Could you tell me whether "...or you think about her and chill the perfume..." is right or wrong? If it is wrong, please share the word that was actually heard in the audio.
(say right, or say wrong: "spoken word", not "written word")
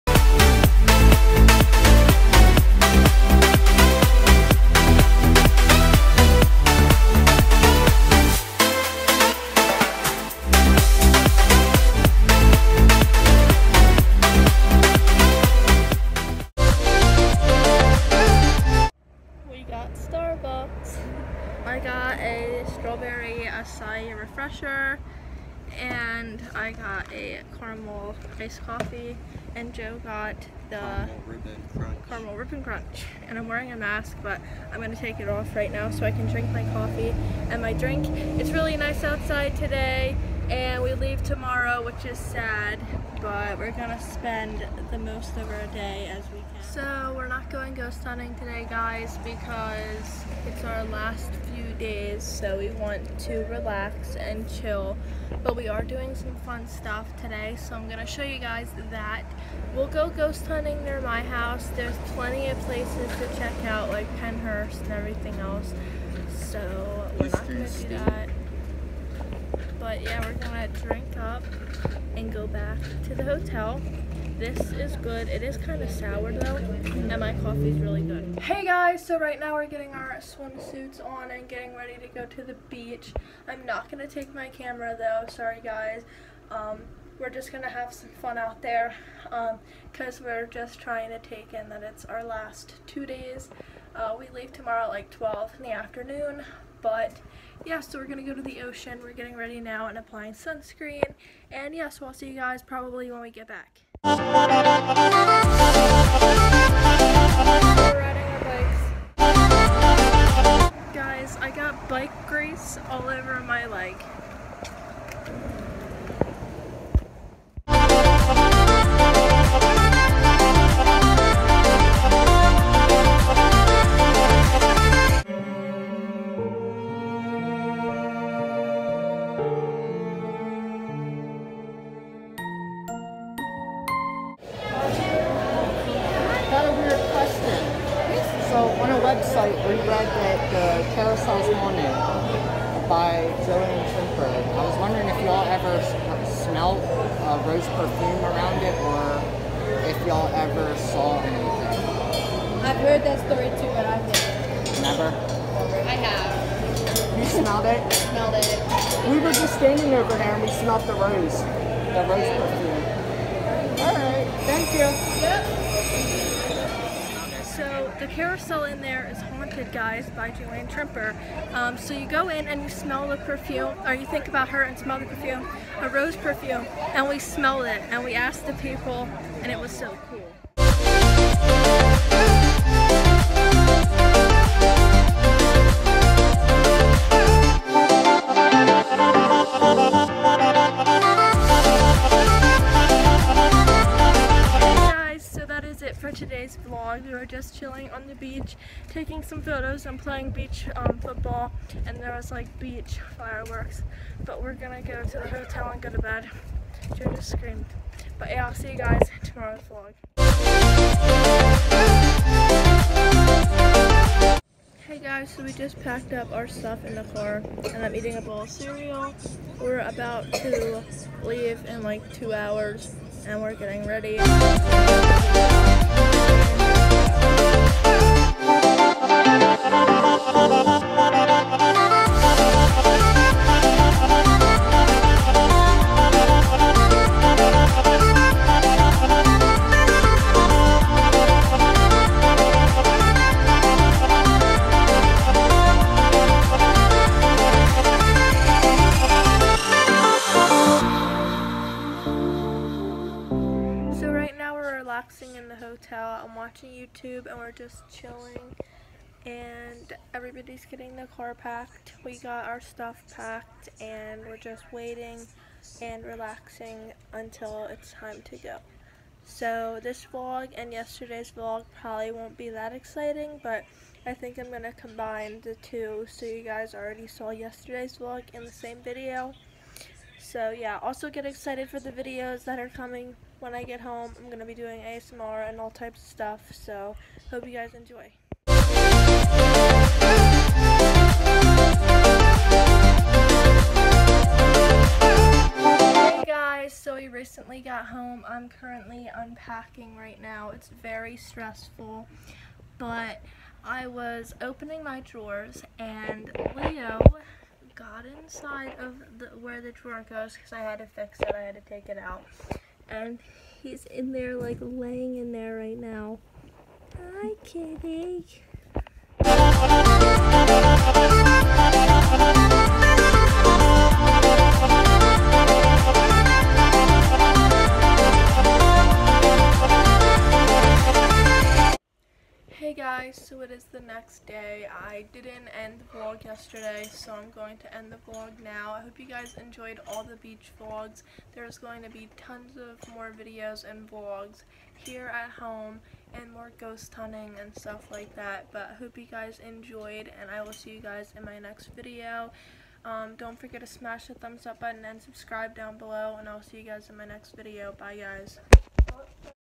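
wrong: "smell", not "chill".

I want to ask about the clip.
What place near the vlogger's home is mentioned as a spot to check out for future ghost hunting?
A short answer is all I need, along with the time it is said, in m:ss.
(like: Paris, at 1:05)
Pennhurst, at 1:04.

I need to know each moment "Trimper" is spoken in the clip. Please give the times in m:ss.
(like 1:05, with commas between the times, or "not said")
2:23, 2:50.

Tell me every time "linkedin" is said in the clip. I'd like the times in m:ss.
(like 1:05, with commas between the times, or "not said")
not said.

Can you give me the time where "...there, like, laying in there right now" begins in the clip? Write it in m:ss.
5:14.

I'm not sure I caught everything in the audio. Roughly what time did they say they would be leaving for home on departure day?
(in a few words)
12 in the afternoon.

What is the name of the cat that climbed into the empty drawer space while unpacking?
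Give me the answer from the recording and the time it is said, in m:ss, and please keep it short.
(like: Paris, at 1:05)
Leo, at 5:06.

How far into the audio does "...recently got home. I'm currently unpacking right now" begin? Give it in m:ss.
4:57.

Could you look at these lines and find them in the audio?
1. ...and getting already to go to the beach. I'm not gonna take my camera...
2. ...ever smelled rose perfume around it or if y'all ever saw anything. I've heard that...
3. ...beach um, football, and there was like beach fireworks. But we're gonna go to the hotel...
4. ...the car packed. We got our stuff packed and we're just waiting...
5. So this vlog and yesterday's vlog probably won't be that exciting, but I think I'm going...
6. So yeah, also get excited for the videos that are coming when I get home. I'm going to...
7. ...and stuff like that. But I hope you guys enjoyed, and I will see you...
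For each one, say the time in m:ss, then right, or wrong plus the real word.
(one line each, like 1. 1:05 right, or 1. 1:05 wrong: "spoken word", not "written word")
1. 1:21 wrong: "ready", not "already"
2. 2:25 right
3. 3:20 right
4. 4:20 right
5. 4:29 right
6. 4:40 right
7. 5:47 right.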